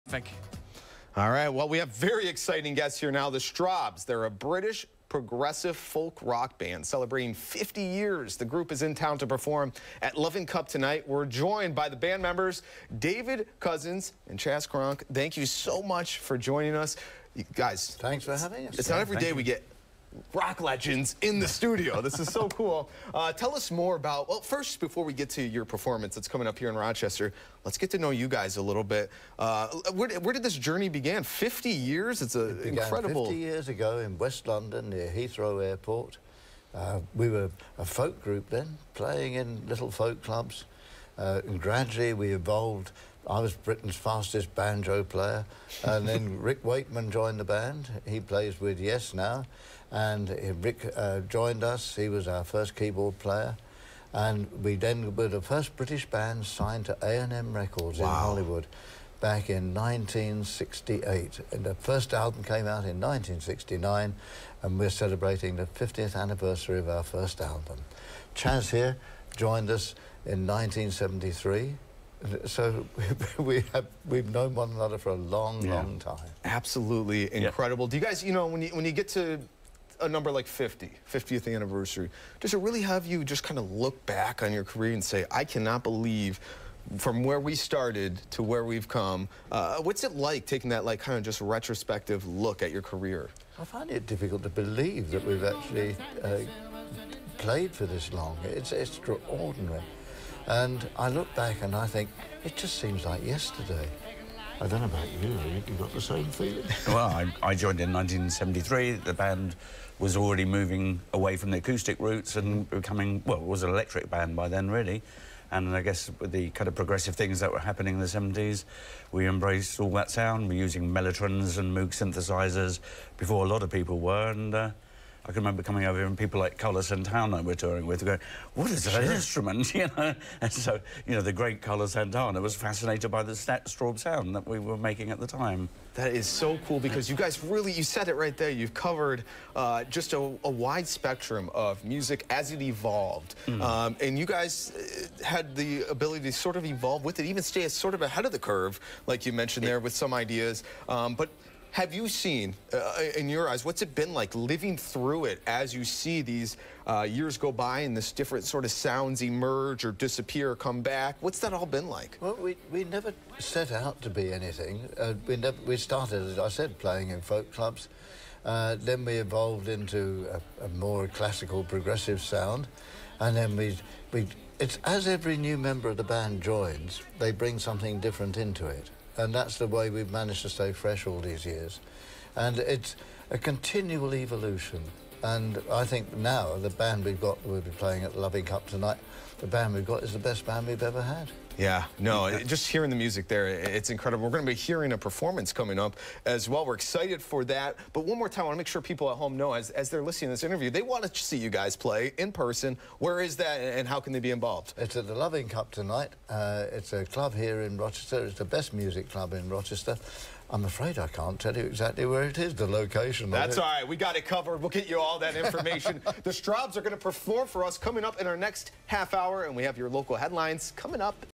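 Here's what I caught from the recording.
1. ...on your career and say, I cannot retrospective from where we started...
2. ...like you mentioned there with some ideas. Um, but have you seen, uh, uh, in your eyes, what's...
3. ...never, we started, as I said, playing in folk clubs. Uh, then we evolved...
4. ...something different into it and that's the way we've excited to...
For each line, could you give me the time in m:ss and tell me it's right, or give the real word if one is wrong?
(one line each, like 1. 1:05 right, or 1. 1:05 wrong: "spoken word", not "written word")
1. 1:24 wrong: "believe", not "retrospective"
2. 2:29 right
3. 2:45 right
4. 2:57 wrong: "managed", not "excited".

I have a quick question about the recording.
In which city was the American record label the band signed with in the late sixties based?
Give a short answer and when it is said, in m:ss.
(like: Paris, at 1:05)
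Hollywood, at 0:58.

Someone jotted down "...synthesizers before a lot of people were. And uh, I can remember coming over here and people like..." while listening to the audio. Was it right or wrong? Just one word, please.
right.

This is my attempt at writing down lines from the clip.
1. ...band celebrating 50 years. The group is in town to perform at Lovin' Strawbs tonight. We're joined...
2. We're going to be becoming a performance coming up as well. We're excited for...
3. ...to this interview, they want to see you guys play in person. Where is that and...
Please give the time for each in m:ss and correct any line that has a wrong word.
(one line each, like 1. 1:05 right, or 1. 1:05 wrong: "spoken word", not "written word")
1. 0:06 wrong: "Cup", not "Strawbs"
2. 3:14 wrong: "hearing", not "becoming"
3. 3:20 right.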